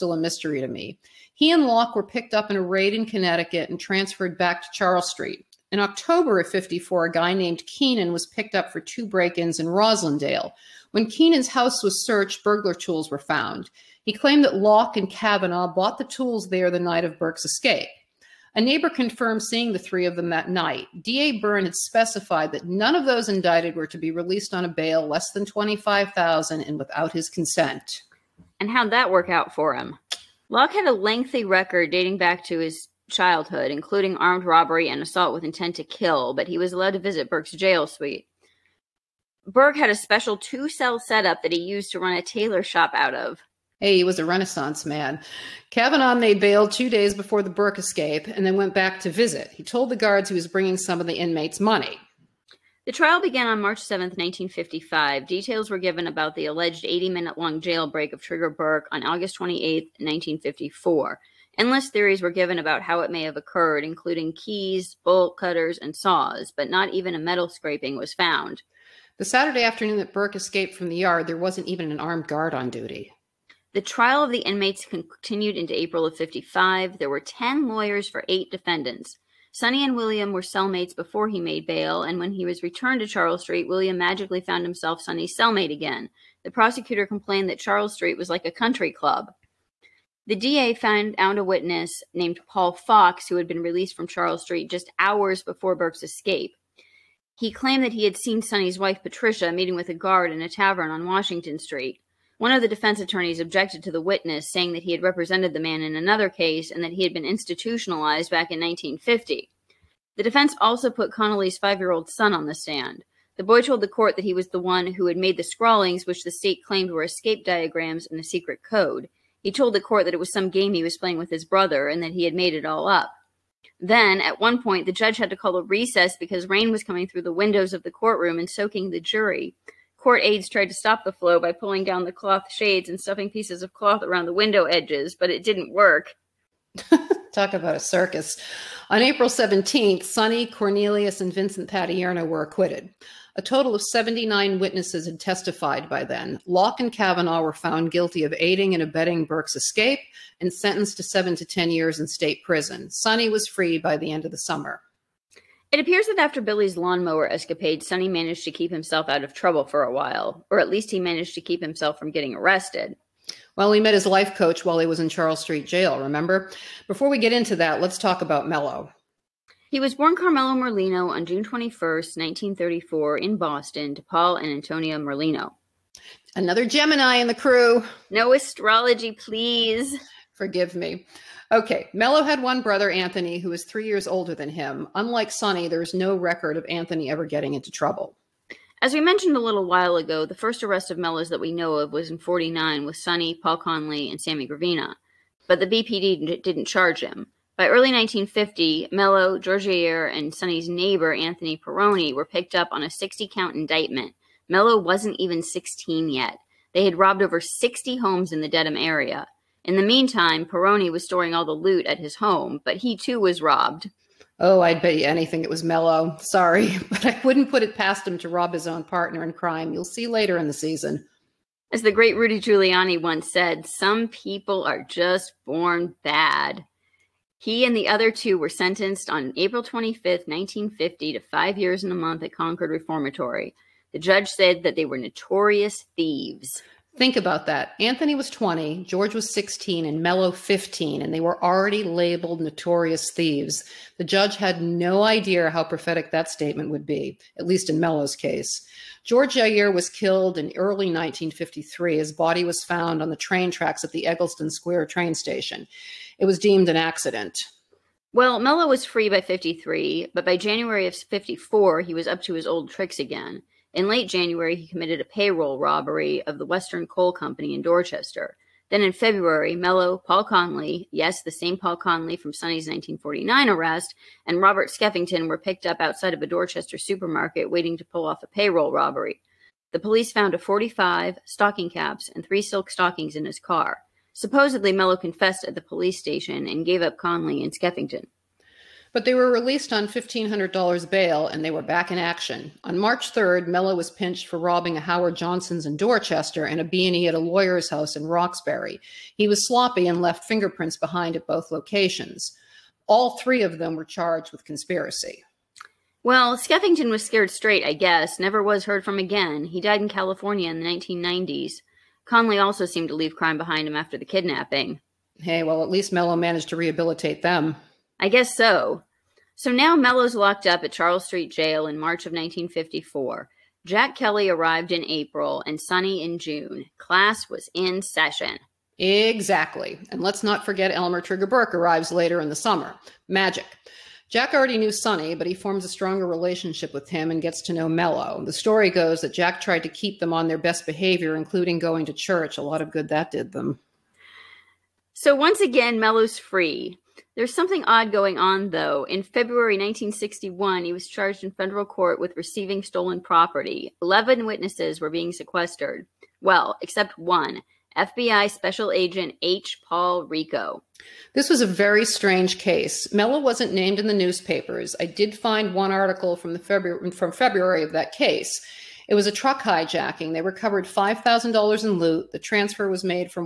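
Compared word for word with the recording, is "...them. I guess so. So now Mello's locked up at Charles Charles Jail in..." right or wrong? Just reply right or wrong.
wrong.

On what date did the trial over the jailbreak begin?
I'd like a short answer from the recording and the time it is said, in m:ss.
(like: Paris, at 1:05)
March 7, 1955, at 0:53.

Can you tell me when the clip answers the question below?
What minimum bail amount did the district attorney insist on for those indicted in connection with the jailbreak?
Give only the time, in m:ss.
0:25.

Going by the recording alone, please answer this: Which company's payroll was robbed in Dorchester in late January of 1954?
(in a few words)
Western Coal Company.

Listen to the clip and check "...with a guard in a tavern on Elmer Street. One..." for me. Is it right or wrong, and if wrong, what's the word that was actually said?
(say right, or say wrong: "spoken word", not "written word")
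wrong: "Washington", not "Elmer".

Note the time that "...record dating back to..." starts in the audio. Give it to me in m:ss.
0:31.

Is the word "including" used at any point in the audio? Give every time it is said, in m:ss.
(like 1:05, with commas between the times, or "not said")
0:33, 1:03, 5:41.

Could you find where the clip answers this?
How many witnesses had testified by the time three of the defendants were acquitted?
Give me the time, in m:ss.
2:23.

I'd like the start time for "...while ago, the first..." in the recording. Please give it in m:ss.
3:09.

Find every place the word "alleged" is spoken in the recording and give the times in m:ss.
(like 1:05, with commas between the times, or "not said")
0:56.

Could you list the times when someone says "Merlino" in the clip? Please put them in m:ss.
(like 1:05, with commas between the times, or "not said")
2:50, 2:54.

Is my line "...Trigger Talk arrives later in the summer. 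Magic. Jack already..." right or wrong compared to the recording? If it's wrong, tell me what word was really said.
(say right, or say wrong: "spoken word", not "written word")
wrong: "Burke", not "Talk".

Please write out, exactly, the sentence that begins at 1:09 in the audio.
The Saturday afternoon that Burke escaped from the yard, there wasn't even an armed guard on duty.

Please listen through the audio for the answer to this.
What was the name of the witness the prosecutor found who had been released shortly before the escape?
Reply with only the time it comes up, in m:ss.
1:32.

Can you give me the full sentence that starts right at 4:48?
But they were released on $1,500 bail and they were back in action.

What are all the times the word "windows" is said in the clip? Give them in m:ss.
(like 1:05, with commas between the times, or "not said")
2:07, 2:14.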